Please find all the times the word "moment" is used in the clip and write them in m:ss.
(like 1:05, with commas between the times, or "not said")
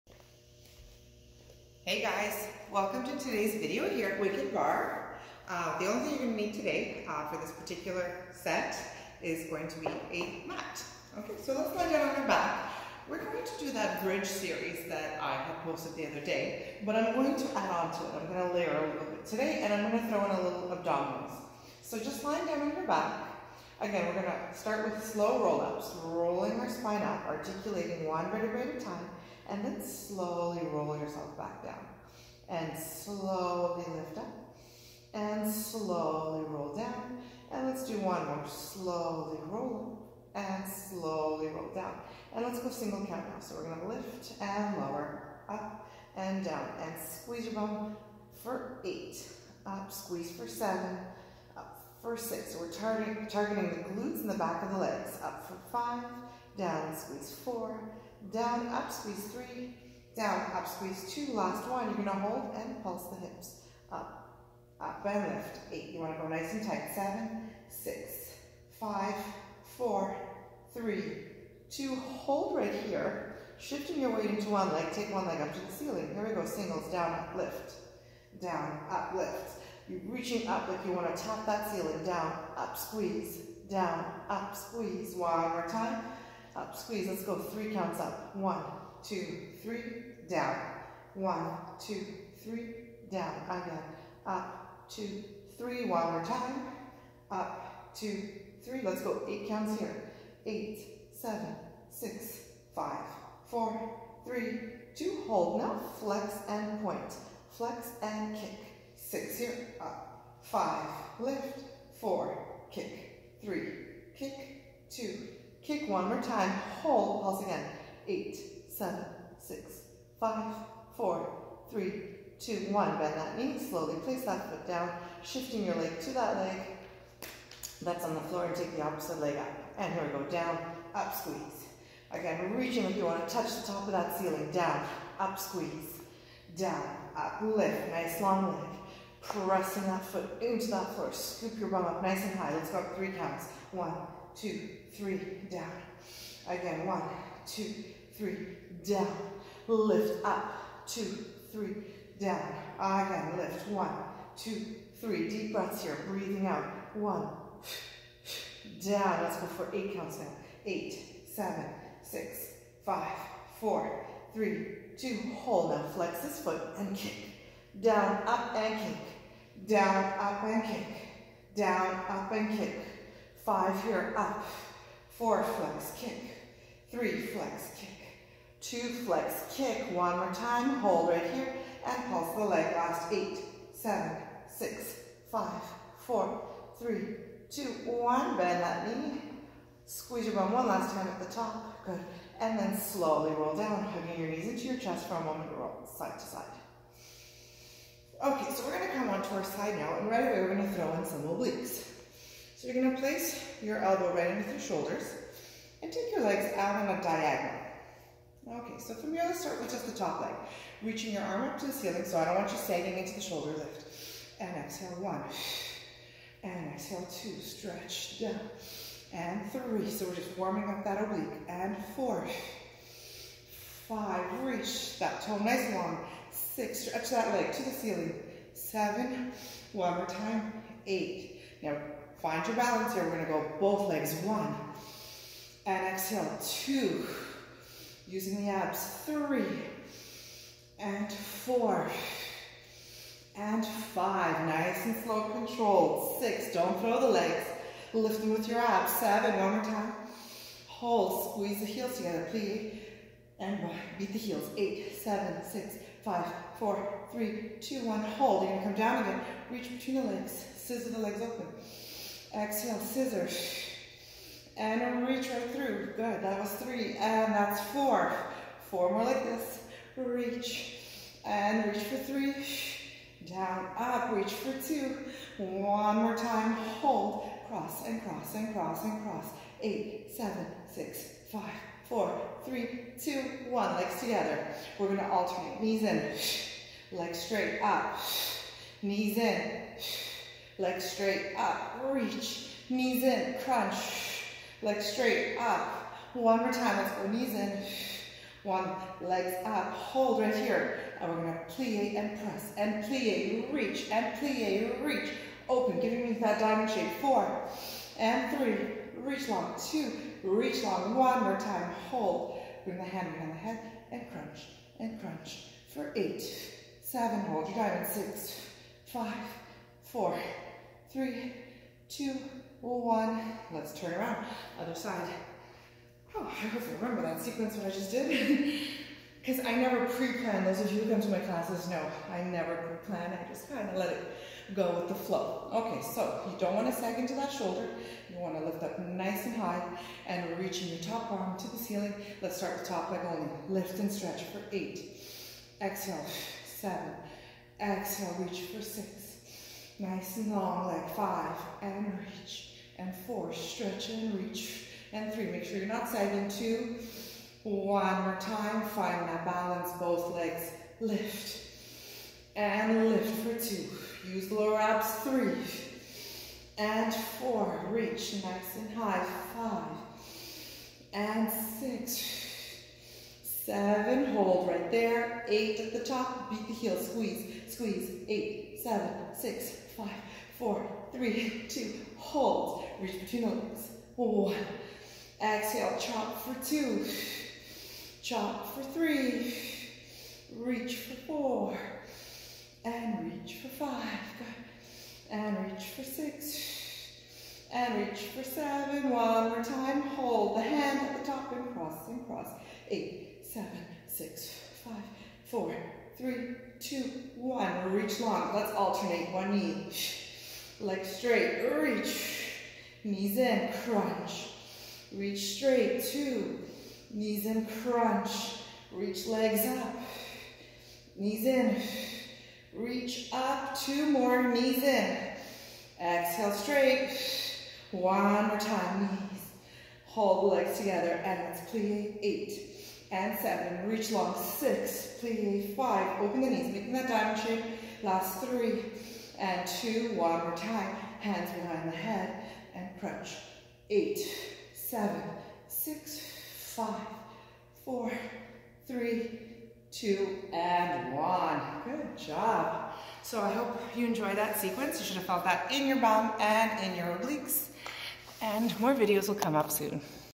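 3:15.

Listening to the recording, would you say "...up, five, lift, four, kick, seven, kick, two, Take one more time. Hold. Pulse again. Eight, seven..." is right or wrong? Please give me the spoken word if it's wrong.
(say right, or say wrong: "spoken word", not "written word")
wrong: "three", not "seven".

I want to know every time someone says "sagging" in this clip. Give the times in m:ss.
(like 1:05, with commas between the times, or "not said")
3:32, 5:55.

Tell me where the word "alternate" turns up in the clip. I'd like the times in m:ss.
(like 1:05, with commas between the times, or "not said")
4:45, 6:48.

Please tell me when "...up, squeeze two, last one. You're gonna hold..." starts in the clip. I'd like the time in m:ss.
1:00.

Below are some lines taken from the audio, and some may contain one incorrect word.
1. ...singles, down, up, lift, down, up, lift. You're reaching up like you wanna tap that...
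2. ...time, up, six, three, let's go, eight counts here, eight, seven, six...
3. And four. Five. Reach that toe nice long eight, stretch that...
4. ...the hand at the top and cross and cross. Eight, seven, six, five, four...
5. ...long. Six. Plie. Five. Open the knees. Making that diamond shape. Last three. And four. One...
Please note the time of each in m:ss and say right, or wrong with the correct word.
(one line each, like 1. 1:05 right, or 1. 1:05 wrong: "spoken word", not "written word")
1. 1:16 right
2. 1:36 wrong: "two", not "six"
3. 3:41 wrong: "six", not "eight"
4. 6:40 right
5. 7:13 wrong: "two", not "four".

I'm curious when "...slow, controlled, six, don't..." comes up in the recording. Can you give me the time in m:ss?
4:05.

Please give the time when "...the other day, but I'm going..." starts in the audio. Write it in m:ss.
0:15.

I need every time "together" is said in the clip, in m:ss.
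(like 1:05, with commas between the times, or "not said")
4:11, 4:43, 7:10.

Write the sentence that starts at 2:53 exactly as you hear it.
Five here, up, four, flex, kick, three, flex, kick, two, flex, kick.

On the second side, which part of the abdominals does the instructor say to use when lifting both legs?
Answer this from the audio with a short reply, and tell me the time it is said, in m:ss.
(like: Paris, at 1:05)
The lower abs, at 6:04.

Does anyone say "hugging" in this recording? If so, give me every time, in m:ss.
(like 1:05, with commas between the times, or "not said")
3:13.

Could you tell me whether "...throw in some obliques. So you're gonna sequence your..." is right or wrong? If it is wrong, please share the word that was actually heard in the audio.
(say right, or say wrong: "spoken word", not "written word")
wrong: "place", not "sequence".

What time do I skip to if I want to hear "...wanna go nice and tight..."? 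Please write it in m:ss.
1:05.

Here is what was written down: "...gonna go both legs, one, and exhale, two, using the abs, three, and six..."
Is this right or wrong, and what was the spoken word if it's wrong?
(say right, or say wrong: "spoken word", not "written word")
wrong: "four", not "six".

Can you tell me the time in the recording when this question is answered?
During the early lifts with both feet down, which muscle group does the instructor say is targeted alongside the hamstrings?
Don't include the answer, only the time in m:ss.
0:53.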